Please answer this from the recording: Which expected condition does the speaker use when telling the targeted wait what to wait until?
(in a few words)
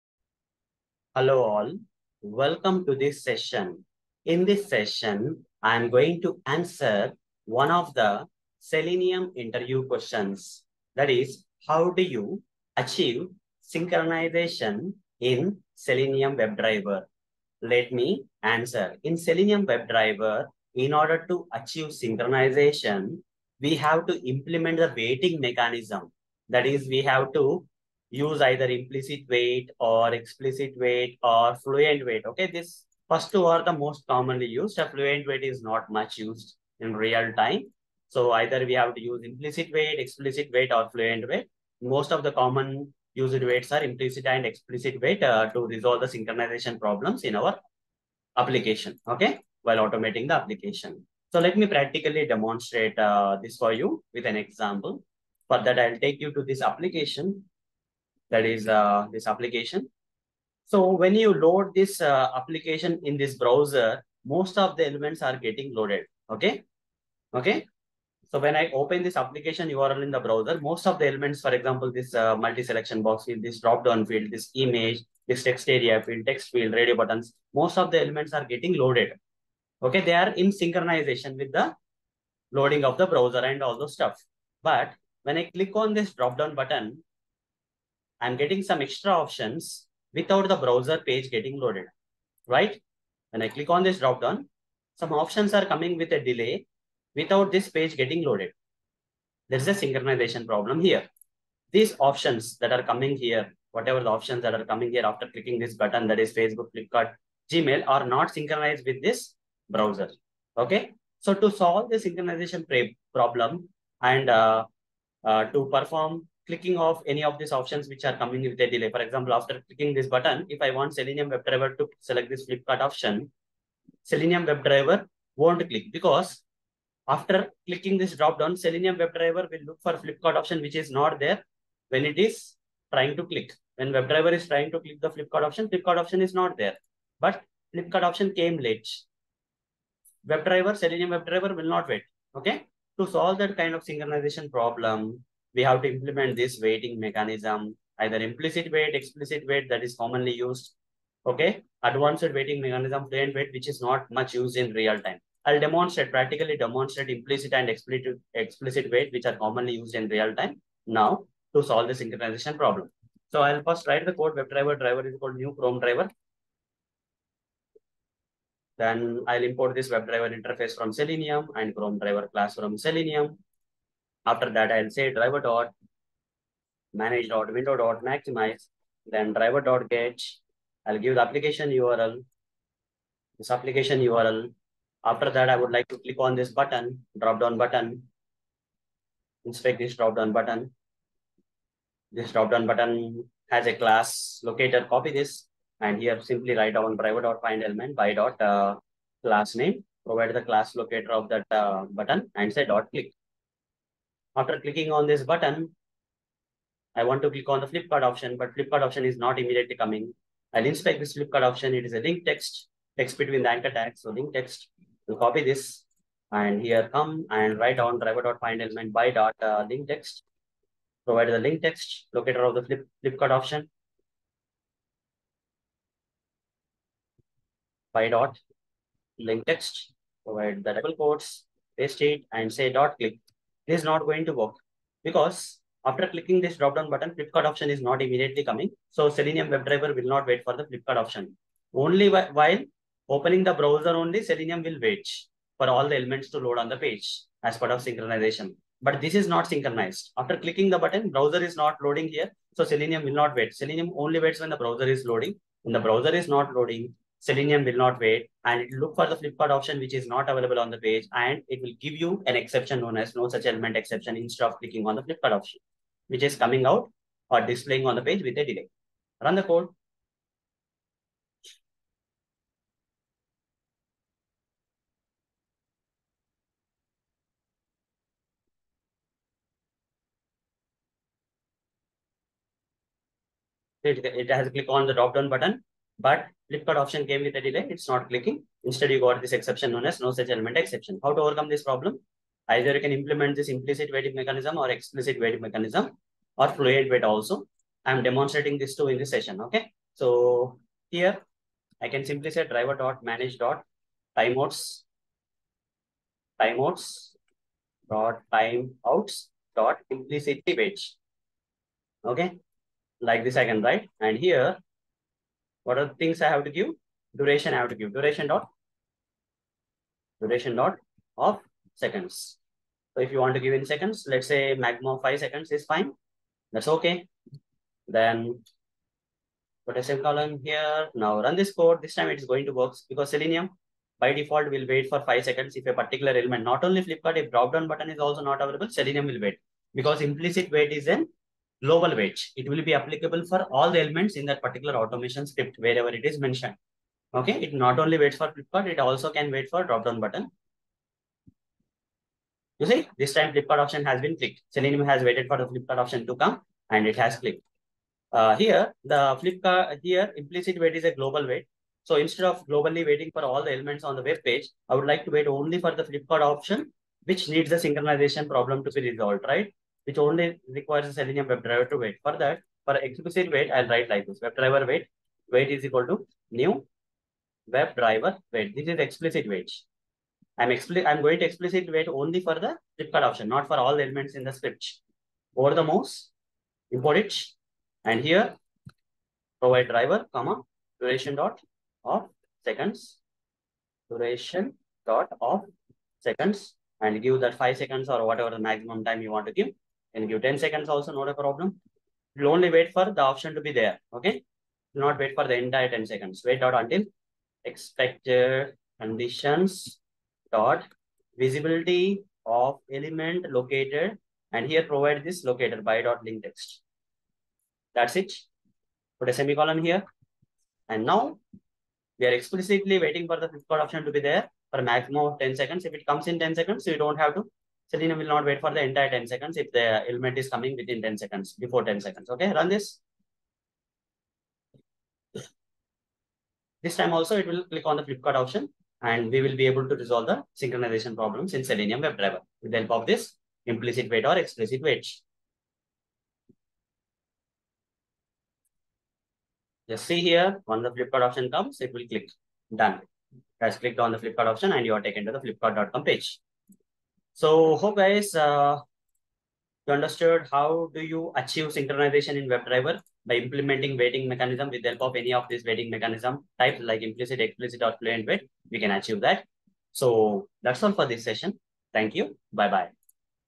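Visibility of element located.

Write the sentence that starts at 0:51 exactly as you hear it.
So let me practically demonstrate uh, this for you with an example.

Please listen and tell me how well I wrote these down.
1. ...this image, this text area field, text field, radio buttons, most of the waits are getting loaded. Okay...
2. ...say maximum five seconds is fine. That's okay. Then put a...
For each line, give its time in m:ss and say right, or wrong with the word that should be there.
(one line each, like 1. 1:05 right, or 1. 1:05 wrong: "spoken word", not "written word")
1. 1:14 wrong: "elements", not "waits"
2. 5:24 right.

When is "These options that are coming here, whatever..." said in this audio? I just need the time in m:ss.
1:41.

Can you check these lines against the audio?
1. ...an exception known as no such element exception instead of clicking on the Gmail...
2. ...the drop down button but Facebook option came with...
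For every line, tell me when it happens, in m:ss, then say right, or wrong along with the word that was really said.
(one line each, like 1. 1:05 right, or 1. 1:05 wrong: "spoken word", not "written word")
1. 4:22 wrong: "Flipkart", not "Gmail"
2. 4:44 wrong: "Flipkart", not "Facebook".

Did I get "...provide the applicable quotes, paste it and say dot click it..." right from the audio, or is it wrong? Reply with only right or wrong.
wrong.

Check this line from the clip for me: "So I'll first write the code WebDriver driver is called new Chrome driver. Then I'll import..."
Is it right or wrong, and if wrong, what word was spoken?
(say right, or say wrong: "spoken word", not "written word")
right.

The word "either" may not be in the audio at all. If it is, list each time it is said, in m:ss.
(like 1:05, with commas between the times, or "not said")
0:28, 0:38, 2:27, 4:52.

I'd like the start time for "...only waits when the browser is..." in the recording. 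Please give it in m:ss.
4:13.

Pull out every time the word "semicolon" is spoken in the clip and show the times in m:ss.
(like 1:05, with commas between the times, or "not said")
5:29, 6:59.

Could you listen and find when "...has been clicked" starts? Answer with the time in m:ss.
5:53.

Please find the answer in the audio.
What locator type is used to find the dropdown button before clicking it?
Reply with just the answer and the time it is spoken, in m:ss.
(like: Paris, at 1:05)
Class name, at 3:19.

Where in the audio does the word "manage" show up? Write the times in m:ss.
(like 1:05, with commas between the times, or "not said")
2:56, 5:03.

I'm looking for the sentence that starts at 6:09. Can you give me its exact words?
which only requires a Selenium WebDriver to wait.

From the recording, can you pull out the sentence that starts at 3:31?
It is a link text, text between the anchor tags.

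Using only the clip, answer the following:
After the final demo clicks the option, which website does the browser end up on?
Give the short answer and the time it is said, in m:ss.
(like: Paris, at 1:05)
flipkart.com, at 7:35.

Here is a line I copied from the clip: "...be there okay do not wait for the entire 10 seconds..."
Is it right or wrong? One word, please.
right.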